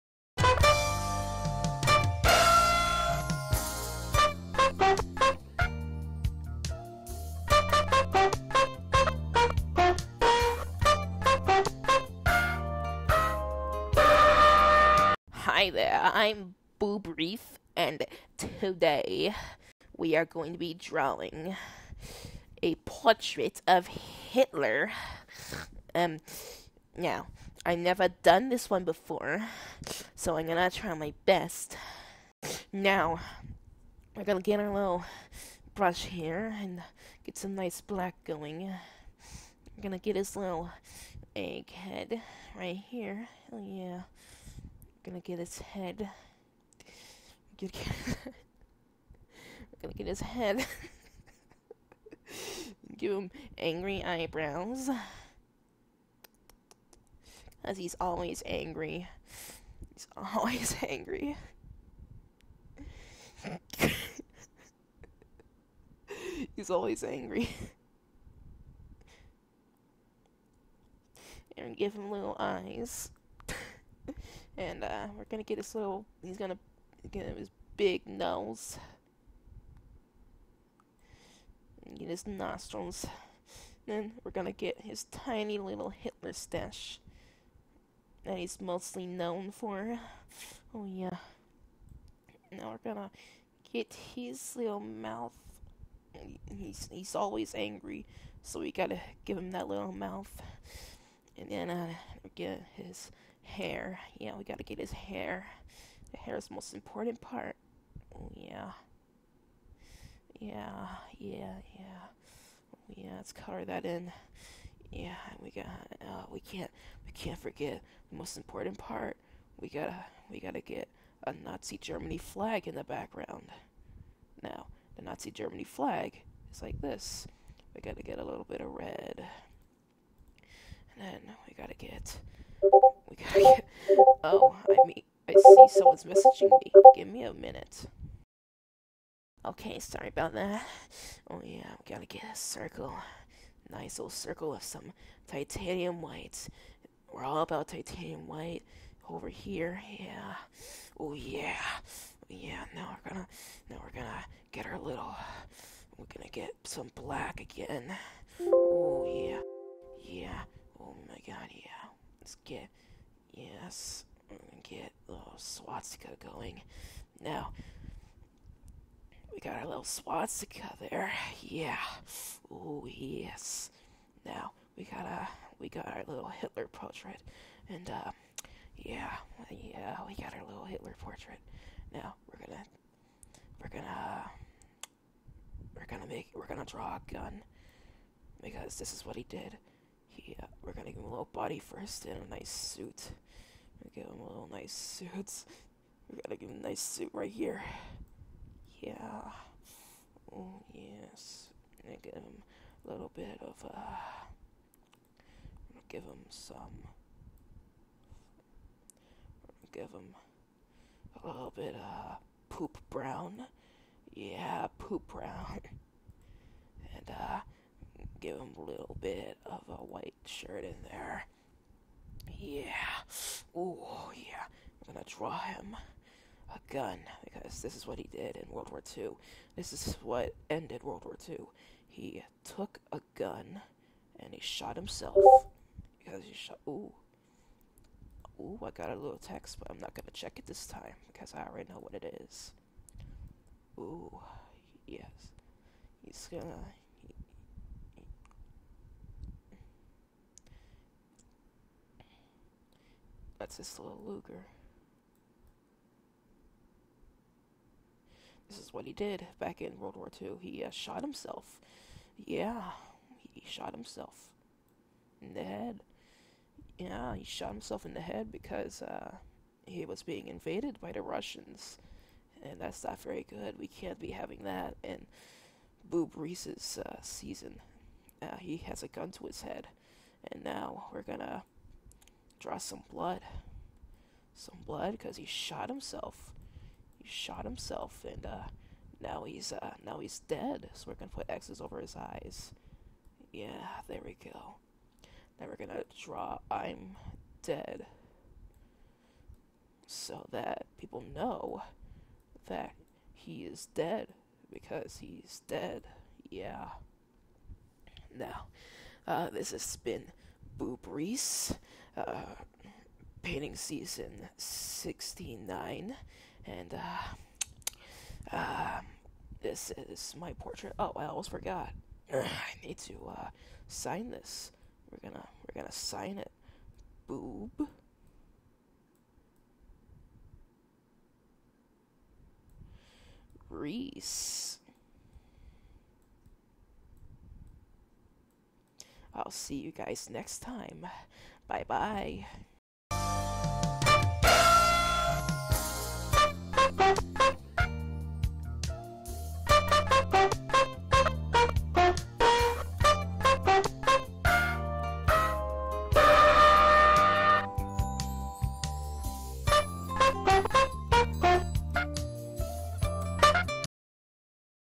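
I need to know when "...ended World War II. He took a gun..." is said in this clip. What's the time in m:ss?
3:50.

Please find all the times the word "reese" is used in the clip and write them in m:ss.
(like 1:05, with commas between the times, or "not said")
0:17, 4:36, 5:10, 5:33.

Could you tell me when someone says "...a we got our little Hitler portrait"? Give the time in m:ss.
2:55.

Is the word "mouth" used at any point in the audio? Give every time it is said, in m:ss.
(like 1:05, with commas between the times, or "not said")
1:34, 1:39.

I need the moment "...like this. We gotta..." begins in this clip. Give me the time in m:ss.
2:06.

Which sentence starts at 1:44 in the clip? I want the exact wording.
Yeah, we gotta get his hair.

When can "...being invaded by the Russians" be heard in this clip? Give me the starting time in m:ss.
4:30.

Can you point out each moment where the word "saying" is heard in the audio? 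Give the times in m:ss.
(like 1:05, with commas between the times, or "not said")
not said.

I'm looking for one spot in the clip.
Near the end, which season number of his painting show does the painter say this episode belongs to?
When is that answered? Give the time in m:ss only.
5:13.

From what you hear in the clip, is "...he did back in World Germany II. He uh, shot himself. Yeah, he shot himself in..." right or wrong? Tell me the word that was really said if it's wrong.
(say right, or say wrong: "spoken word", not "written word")
wrong: "War", not "Germany".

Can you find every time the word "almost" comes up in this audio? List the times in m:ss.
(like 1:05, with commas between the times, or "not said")
5:21.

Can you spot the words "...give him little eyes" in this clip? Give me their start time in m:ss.
1:11.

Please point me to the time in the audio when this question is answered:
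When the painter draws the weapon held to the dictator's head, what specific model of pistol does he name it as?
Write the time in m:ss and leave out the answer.
4:14.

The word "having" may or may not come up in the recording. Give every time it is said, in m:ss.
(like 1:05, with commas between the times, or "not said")
4:34.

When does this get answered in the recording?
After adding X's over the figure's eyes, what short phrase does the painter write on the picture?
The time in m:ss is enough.
4:56.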